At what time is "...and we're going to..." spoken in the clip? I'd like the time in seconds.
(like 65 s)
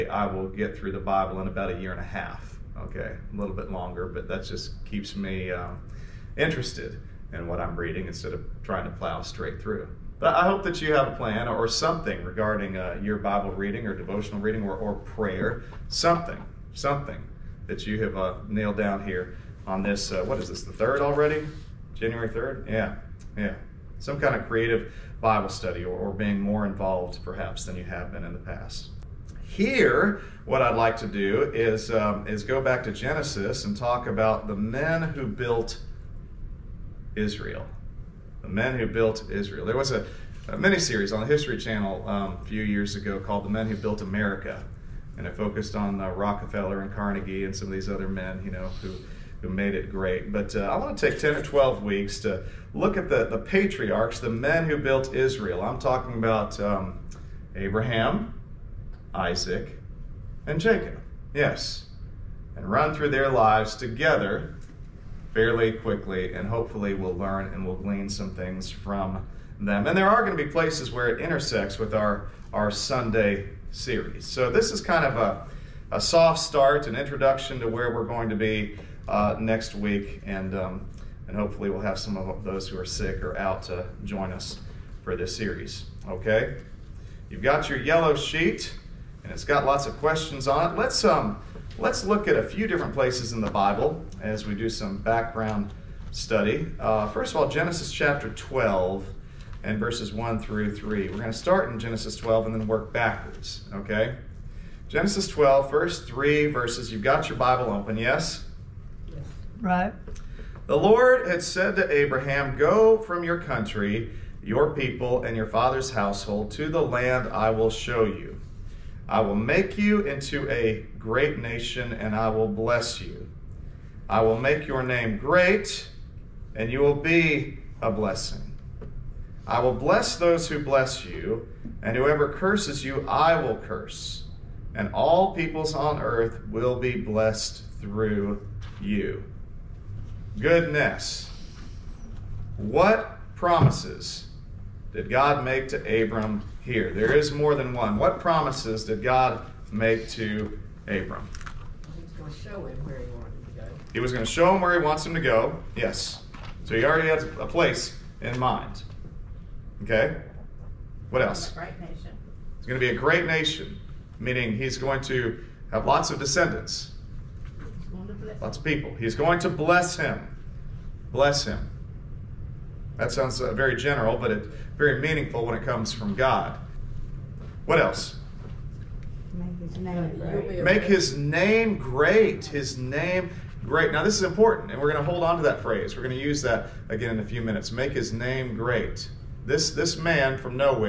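184 s.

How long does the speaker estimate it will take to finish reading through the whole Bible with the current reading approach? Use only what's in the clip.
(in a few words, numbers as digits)
a year and a half.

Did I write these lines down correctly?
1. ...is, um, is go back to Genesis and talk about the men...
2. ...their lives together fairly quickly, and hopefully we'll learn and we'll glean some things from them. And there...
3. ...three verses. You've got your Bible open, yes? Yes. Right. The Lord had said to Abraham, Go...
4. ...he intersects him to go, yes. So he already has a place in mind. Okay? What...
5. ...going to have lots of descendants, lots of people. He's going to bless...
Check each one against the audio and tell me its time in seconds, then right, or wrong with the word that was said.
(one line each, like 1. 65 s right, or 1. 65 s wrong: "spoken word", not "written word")
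1. 31 s right
2. 63 s right
3. 106 s right
4. 154 s wrong: "wants", not "intersects"
5. 164 s right.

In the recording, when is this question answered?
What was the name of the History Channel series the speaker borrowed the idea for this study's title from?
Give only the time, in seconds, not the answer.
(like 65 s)
43 s.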